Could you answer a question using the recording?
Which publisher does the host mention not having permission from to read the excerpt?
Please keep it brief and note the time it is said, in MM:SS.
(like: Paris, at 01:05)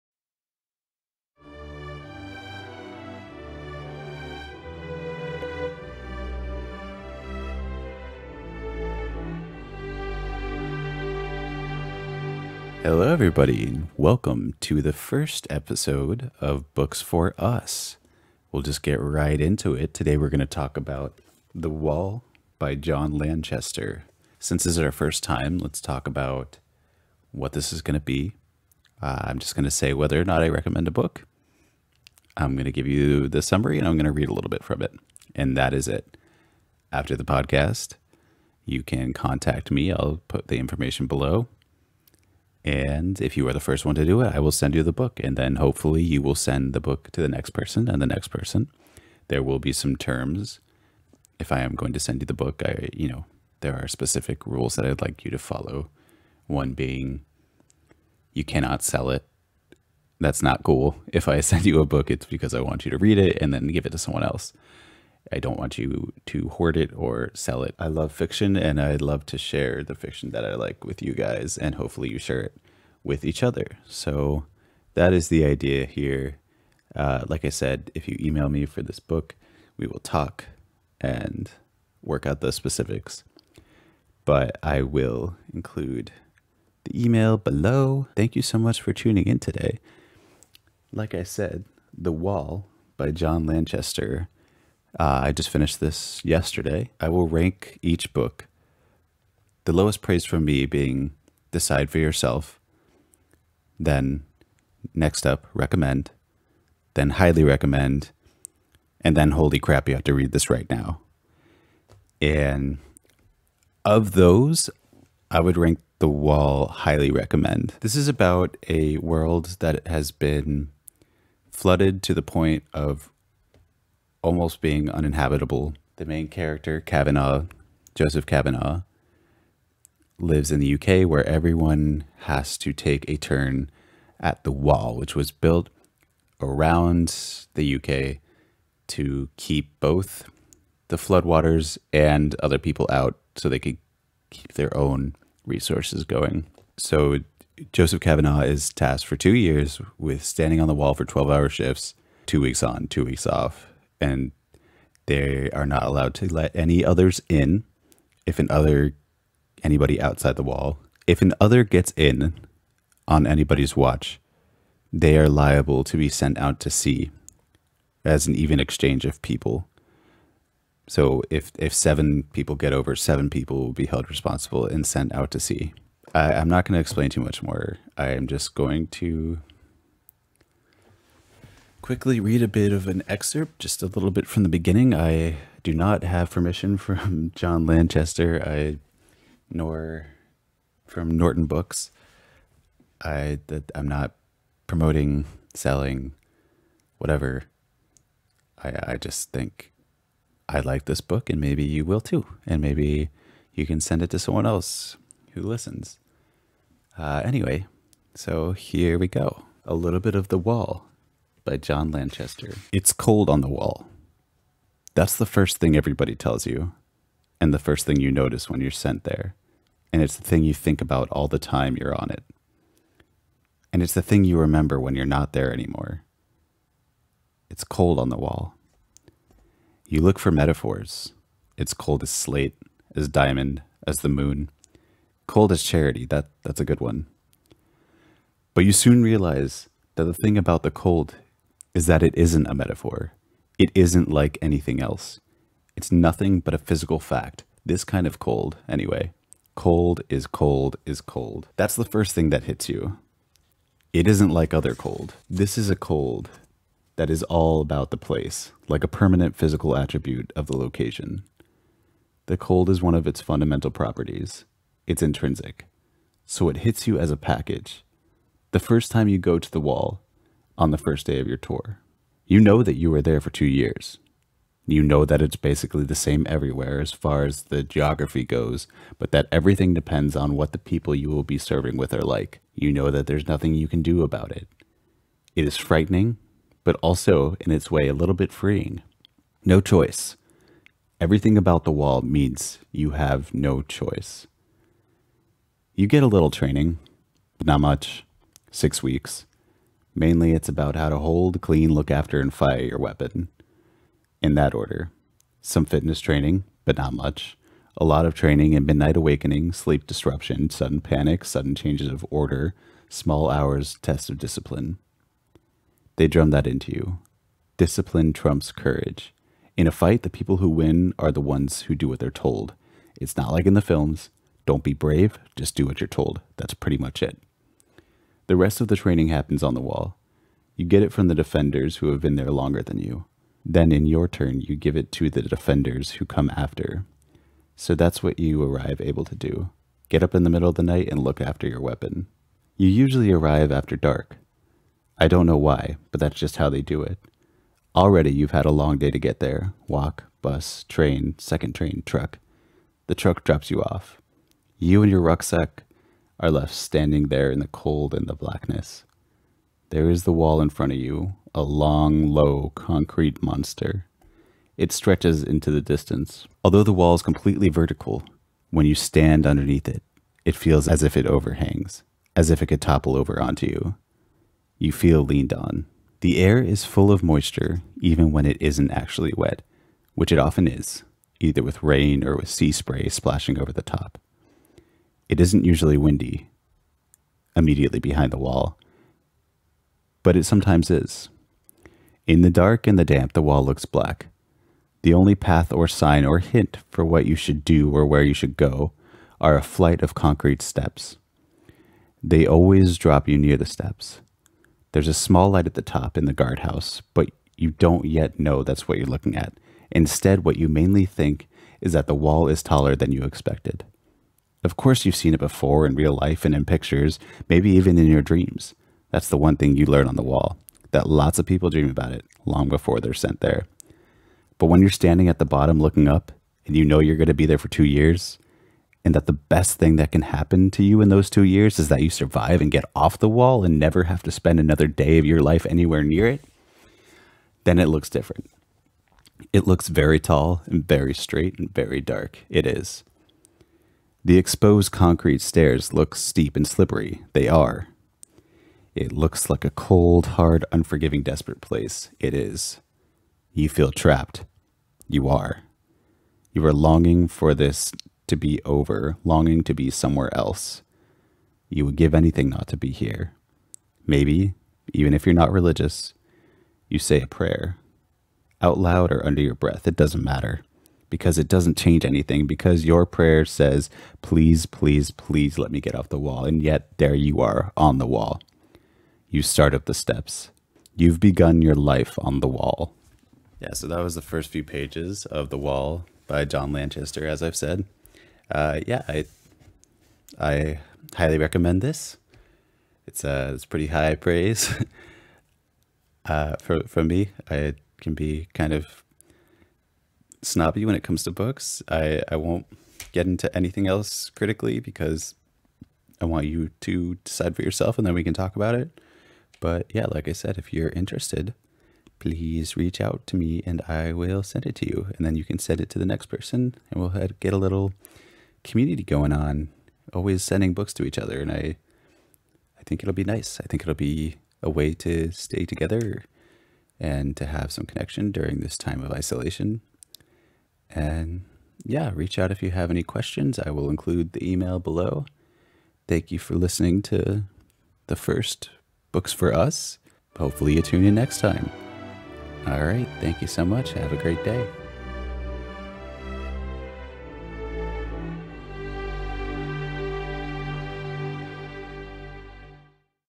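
Norton Books, at 03:11.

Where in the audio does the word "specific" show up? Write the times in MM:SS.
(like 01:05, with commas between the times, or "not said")
00:53, 01:22.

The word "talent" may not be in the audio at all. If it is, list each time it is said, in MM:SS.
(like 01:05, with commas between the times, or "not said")
not said.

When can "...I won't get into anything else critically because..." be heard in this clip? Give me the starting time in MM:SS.
08:22.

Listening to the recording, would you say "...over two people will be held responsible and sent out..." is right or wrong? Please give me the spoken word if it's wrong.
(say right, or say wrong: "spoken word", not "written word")
wrong: "seven", not "two".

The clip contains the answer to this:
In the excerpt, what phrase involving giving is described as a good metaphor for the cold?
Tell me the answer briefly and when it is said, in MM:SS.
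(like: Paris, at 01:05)
Cold as charity, at 03:55.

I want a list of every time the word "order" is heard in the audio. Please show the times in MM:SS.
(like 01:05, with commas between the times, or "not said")
05:04, 05:12.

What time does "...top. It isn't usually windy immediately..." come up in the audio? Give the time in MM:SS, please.
06:23.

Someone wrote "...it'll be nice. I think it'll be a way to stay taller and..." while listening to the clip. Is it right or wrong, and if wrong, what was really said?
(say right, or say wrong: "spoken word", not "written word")
wrong: "together", not "taller".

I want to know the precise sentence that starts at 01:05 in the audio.
I don't want you to hoard it or sell it.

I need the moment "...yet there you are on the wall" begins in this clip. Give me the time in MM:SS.
07:56.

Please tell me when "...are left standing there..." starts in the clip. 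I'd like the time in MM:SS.
05:56.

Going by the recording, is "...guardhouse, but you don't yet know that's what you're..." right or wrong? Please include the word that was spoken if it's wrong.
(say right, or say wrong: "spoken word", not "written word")
right.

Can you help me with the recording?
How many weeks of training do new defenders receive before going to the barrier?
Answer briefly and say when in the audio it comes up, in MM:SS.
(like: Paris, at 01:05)
6 weeks, at 04:58.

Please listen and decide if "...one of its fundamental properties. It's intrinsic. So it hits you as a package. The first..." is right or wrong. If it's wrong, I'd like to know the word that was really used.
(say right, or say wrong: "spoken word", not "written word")
right.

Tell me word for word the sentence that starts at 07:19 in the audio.
It looks very tall and very straight and very dark.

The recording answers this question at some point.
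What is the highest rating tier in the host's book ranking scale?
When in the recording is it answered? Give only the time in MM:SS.
01:49.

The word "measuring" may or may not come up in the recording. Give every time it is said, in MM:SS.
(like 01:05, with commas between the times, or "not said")
not said.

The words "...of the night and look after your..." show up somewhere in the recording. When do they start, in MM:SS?
05:40.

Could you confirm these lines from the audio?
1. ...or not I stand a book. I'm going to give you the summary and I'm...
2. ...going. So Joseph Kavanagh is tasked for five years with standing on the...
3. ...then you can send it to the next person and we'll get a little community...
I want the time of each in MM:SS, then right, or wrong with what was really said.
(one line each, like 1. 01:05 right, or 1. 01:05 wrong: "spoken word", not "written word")
1. 00:30 wrong: "recommend", not "stand"
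2. 02:26 wrong: "two", not "five"
3. 08:35 right.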